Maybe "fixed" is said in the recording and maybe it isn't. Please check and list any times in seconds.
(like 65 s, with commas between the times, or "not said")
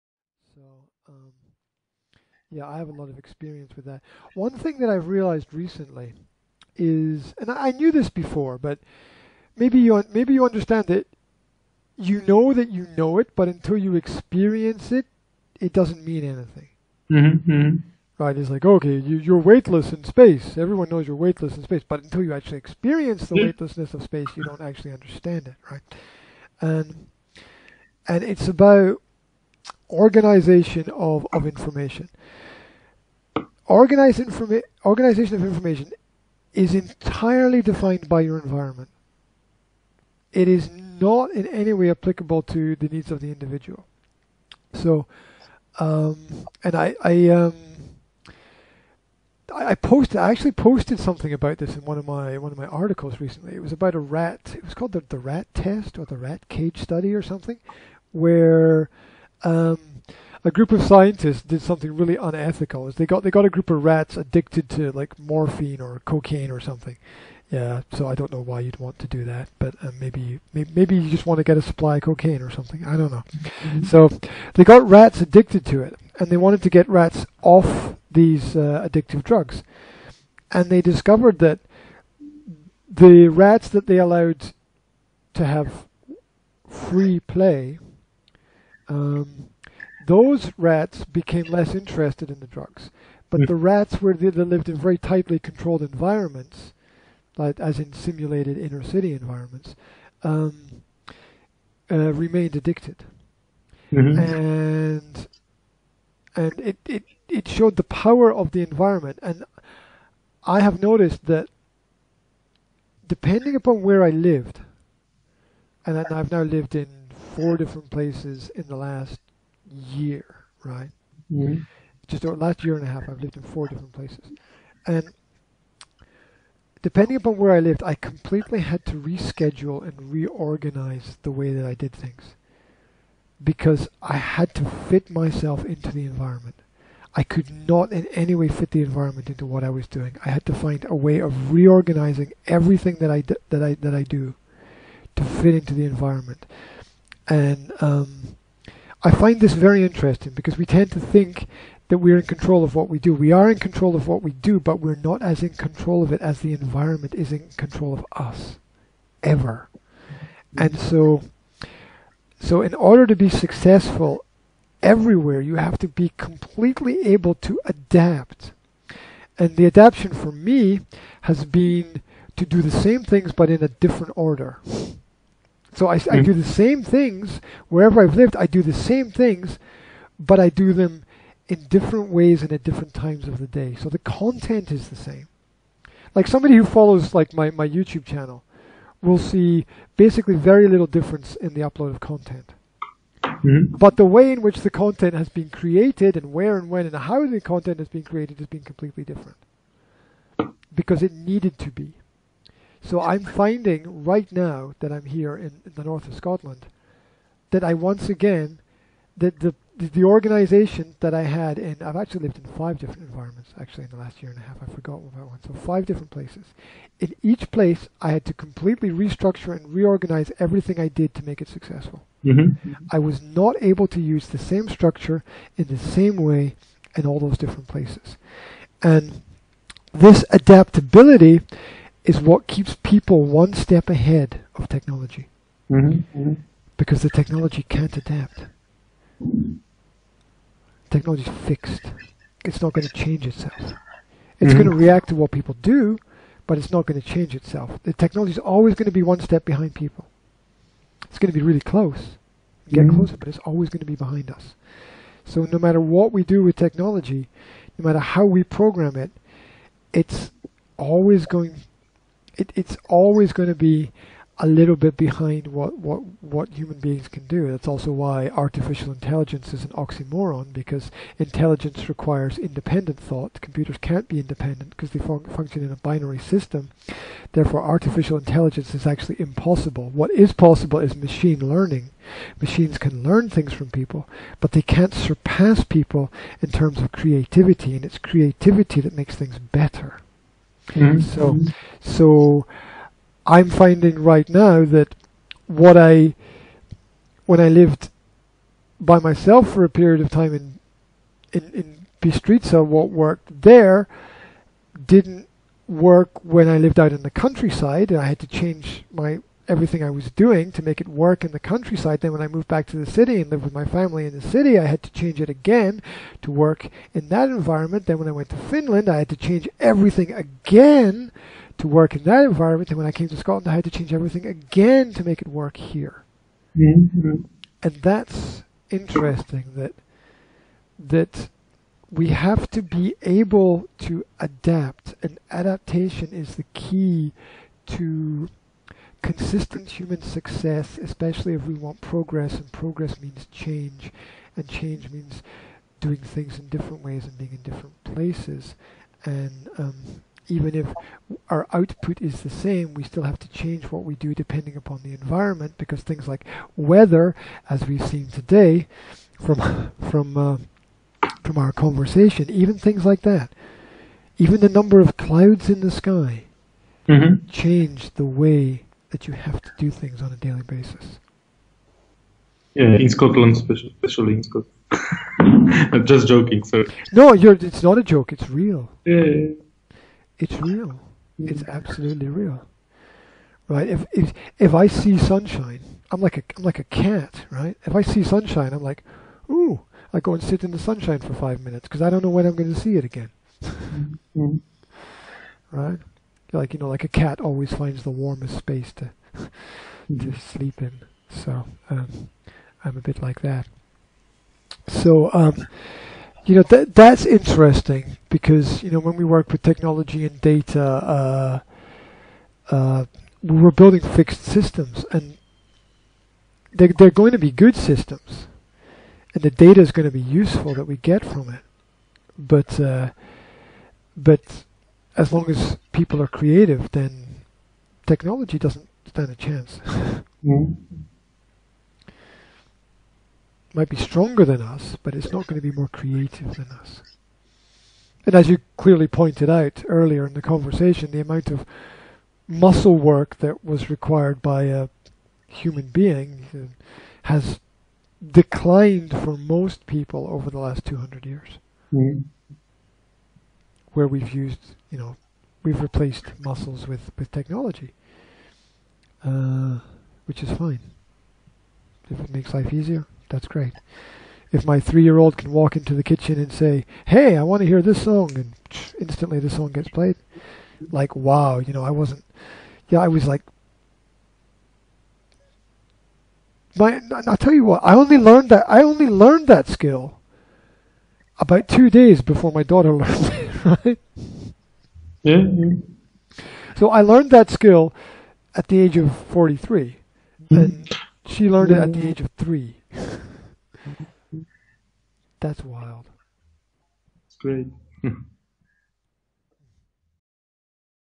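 241 s, 413 s.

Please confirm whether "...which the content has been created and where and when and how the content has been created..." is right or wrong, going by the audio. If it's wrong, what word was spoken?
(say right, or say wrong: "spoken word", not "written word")
right.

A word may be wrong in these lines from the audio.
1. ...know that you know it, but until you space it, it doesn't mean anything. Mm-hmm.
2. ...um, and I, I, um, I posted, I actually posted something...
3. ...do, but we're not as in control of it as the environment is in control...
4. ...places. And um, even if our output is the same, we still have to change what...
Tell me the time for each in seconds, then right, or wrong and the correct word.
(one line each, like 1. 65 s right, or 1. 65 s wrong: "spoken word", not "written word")
1. 12 s wrong: "experience", not "space"
2. 45 s right
3. 154 s right
4. 347 s right.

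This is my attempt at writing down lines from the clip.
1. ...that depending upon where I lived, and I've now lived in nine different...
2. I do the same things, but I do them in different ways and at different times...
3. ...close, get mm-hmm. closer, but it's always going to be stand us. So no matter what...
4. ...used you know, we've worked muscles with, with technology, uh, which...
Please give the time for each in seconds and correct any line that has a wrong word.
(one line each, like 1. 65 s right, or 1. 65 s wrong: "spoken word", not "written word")
1. 111 s wrong: "four", not "nine"
2. 178 s right
3. 251 s wrong: "behind", not "stand"
4. 454 s wrong: "replaced", not "worked".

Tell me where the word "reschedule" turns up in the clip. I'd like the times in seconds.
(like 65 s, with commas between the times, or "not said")
128 s.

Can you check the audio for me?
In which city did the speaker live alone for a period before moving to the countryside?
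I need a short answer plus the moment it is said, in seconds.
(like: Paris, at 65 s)
Bystrica, at 302 s.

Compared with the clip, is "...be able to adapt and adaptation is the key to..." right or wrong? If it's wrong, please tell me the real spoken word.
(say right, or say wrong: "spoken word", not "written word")
right.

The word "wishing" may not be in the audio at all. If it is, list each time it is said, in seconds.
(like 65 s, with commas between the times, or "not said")
not said.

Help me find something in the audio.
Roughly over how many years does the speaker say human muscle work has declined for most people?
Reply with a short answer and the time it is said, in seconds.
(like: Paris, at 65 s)
200 years, at 450 s.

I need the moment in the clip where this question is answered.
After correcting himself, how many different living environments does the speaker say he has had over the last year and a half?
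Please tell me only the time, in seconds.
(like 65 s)
215 s.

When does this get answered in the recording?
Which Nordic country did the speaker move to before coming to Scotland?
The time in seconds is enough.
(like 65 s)
318 s.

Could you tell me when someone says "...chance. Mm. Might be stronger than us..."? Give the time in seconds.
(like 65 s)
429 s.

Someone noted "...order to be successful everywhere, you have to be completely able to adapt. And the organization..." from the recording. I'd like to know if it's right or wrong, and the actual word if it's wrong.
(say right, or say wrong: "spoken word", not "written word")
wrong: "adaptation", not "organization".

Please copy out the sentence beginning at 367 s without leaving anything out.
change the way that you have to do things on a daily basis.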